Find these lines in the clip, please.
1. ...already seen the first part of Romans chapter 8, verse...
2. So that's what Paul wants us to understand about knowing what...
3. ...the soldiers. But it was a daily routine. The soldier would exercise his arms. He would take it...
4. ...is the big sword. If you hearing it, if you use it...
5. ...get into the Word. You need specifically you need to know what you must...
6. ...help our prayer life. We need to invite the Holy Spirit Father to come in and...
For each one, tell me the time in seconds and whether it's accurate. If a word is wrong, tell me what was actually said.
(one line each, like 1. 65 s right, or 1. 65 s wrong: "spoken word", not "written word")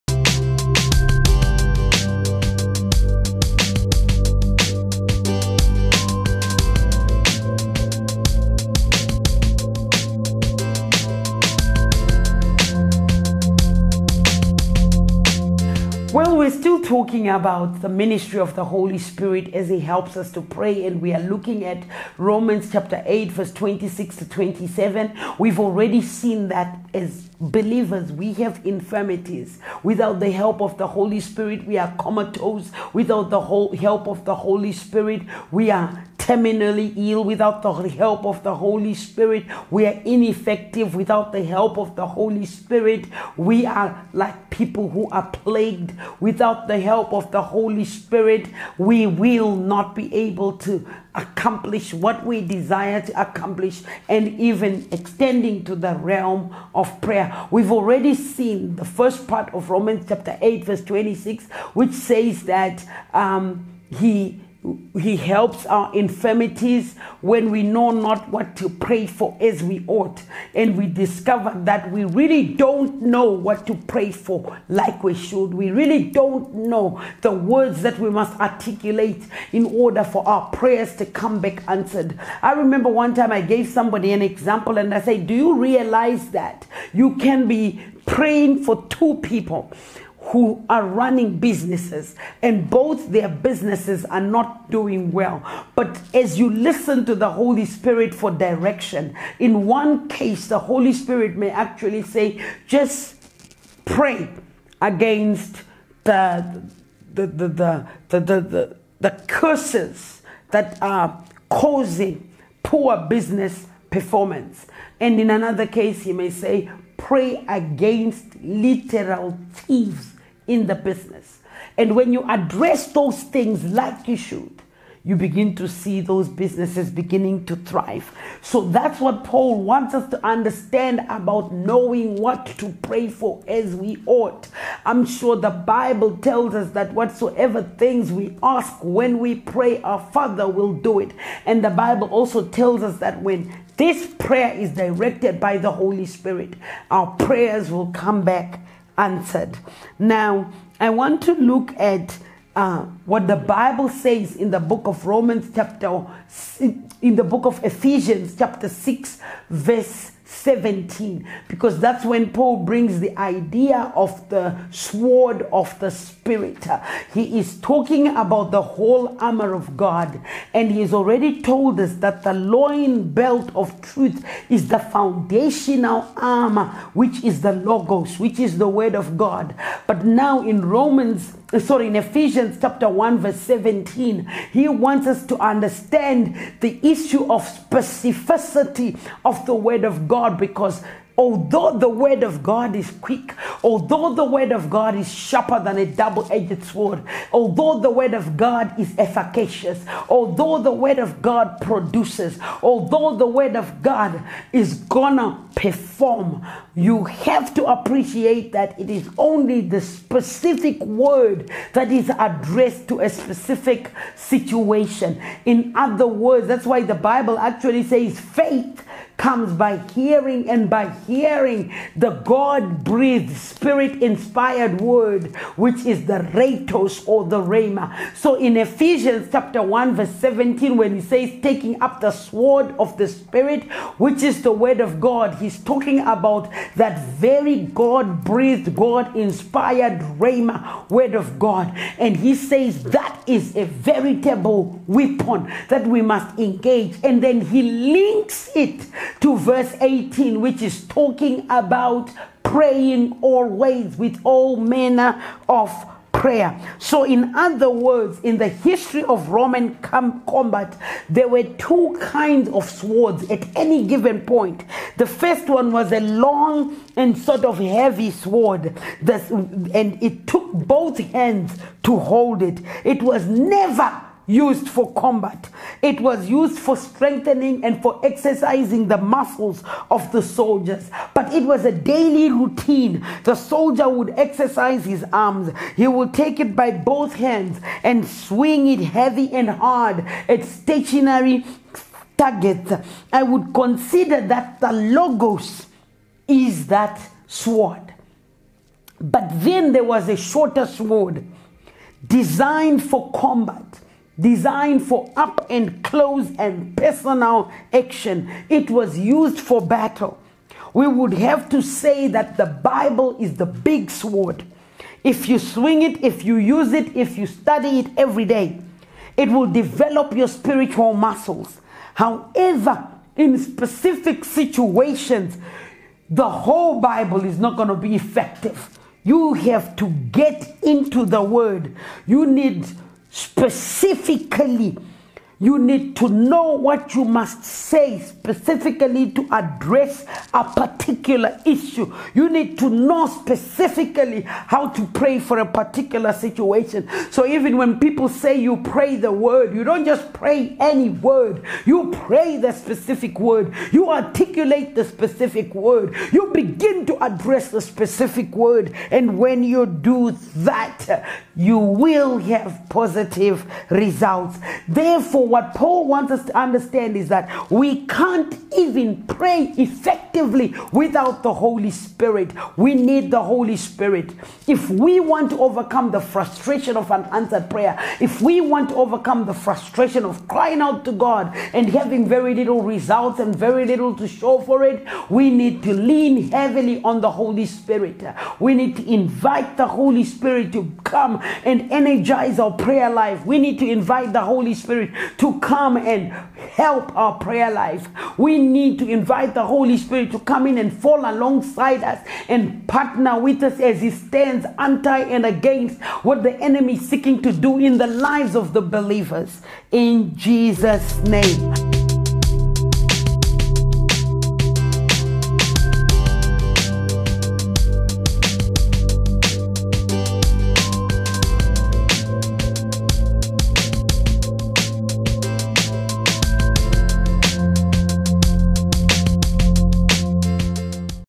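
1. 57 s right
2. 128 s right
3. 280 s right
4. 313 s wrong: "swing", not "hearing"
5. 330 s right
6. 396 s wrong: "Spirit", not "Father".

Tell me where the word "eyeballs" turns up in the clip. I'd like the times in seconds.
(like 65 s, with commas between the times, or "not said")
not said.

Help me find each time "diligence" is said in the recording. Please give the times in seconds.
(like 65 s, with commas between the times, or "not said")
not said.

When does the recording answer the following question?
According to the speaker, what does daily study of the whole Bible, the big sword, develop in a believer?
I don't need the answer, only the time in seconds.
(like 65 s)
320 s.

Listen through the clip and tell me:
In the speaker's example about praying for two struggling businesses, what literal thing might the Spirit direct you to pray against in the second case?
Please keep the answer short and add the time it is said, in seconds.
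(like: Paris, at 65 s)
Literal thieves, at 118 s.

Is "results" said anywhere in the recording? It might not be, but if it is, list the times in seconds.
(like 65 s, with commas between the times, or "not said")
363 s, 382 s.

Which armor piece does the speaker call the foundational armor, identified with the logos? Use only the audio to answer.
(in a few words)
The loin belt of truth.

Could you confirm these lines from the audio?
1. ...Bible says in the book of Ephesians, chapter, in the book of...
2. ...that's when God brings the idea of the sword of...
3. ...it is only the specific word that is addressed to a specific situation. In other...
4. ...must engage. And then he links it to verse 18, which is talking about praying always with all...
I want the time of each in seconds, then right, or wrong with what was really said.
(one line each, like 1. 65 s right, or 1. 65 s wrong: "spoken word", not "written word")
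1. 153 s wrong: "Romans", not "Ephesians"
2. 161 s wrong: "Paul", not "God"
3. 208 s right
4. 246 s right.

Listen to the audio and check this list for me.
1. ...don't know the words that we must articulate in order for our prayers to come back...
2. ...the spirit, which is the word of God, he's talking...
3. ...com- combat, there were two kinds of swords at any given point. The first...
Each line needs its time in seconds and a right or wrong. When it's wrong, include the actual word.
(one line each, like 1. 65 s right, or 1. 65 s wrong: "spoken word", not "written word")
1. 76 s right
2. 232 s right
3. 259 s right.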